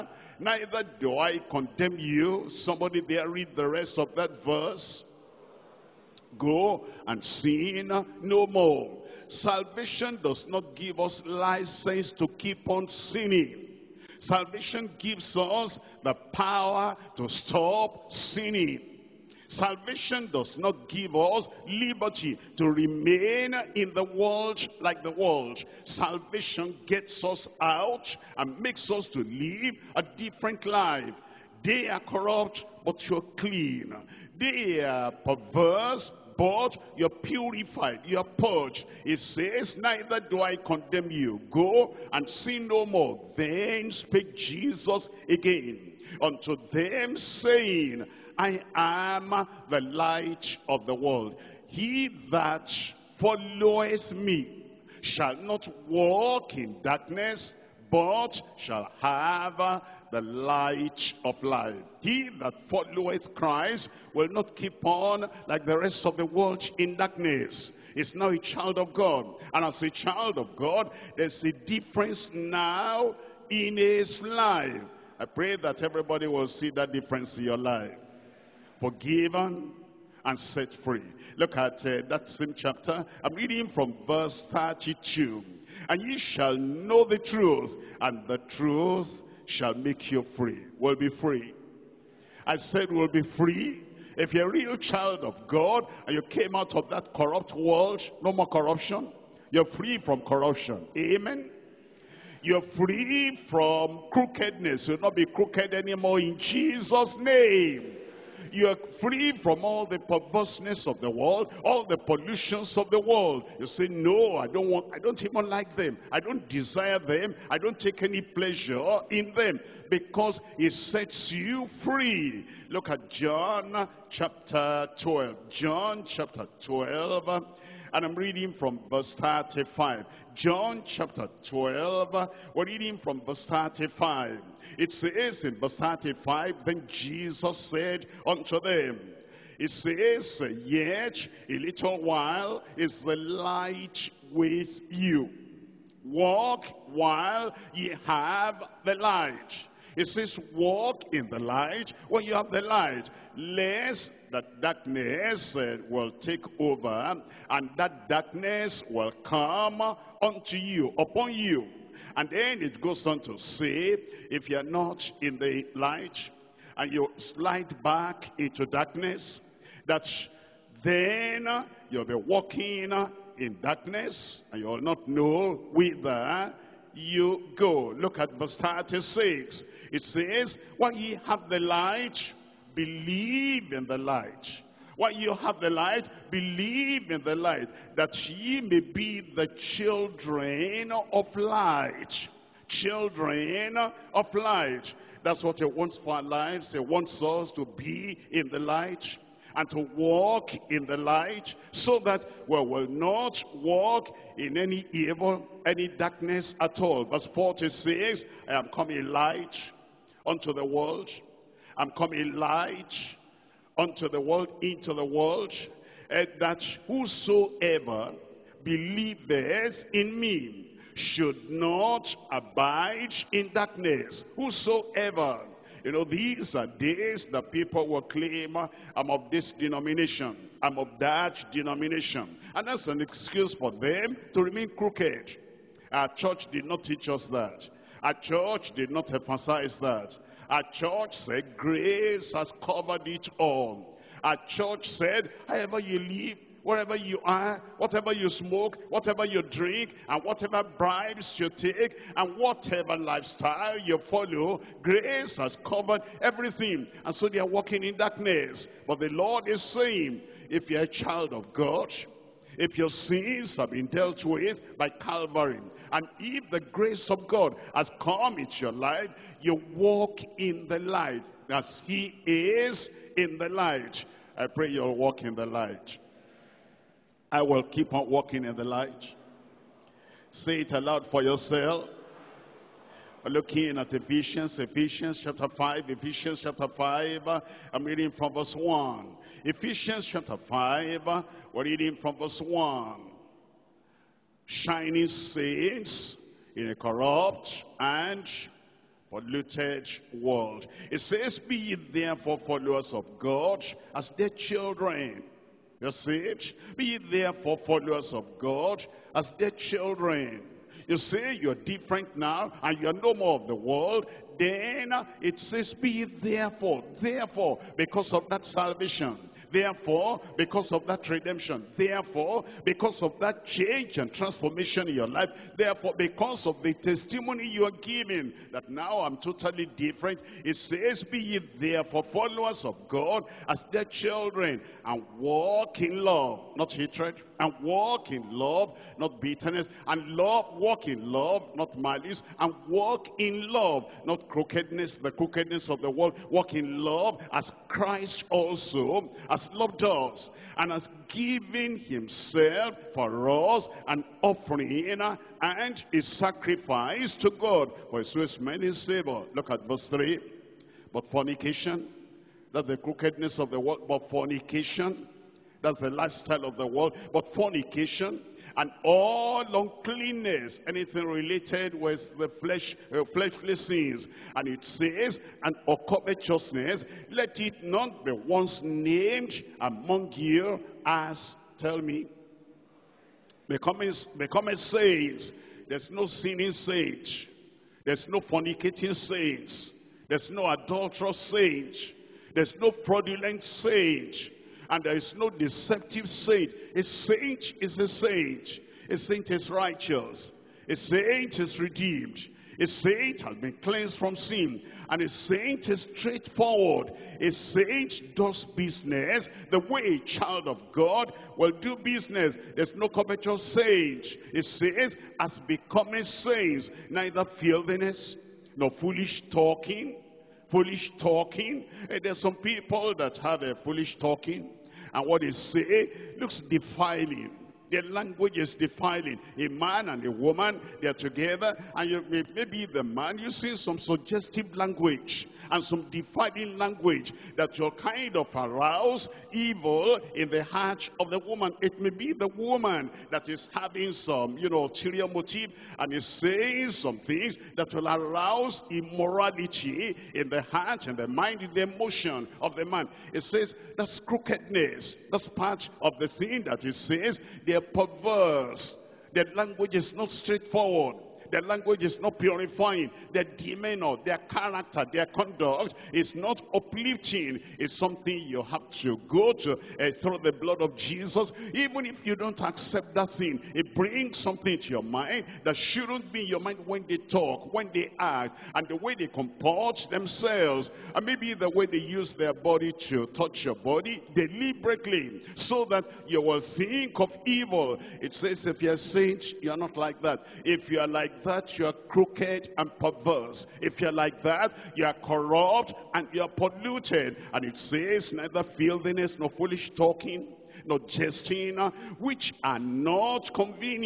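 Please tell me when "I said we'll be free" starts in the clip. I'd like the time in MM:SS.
01:32.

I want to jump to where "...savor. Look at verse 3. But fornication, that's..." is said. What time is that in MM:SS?
05:58.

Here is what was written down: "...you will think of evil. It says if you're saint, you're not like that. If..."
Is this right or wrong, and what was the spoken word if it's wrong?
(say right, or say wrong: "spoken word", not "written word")
right.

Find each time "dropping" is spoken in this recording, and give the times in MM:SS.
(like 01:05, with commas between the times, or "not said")
not said.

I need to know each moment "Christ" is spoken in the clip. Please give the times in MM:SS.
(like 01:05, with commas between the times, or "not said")
01:03, 05:47.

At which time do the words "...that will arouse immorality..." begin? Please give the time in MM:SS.
07:27.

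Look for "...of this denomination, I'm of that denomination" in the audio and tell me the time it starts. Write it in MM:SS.
03:49.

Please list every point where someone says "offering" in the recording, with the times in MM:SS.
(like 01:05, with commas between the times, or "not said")
05:54.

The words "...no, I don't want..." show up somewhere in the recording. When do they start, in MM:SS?
01:53.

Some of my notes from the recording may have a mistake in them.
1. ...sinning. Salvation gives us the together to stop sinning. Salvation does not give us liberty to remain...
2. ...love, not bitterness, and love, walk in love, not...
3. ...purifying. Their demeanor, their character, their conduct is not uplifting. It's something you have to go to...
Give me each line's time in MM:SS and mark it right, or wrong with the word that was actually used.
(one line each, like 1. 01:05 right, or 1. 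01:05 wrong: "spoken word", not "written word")
1. 00:12 wrong: "power", not "together"
2. 05:38 right
3. 07:42 right.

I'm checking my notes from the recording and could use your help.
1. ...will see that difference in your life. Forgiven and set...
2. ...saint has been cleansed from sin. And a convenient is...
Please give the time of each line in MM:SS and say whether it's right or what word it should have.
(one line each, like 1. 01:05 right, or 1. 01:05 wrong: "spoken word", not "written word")
1. 01:16 right
2. 06:42 wrong: "saint", not "convenient".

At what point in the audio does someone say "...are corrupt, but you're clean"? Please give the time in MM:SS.
00:31.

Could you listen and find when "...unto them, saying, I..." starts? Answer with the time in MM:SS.
00:46.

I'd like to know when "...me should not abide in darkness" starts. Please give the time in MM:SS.
03:40.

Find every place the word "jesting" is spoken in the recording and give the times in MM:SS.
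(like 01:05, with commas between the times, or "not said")
08:20.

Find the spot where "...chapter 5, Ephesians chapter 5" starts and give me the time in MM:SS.
04:45.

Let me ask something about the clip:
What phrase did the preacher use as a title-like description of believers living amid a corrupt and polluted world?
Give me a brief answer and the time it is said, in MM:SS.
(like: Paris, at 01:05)
Shining saints, at 04:54.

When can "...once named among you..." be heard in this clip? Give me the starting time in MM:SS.
06:18.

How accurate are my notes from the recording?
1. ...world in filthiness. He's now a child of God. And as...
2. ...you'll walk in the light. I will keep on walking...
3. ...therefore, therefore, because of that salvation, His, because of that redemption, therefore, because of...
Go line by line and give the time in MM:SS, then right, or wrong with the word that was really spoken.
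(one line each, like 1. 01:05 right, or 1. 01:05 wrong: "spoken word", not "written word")
1. 01:06 wrong: "darkness", not "filthiness"
2. 04:34 right
3. 05:16 wrong: "Therefore", not "His".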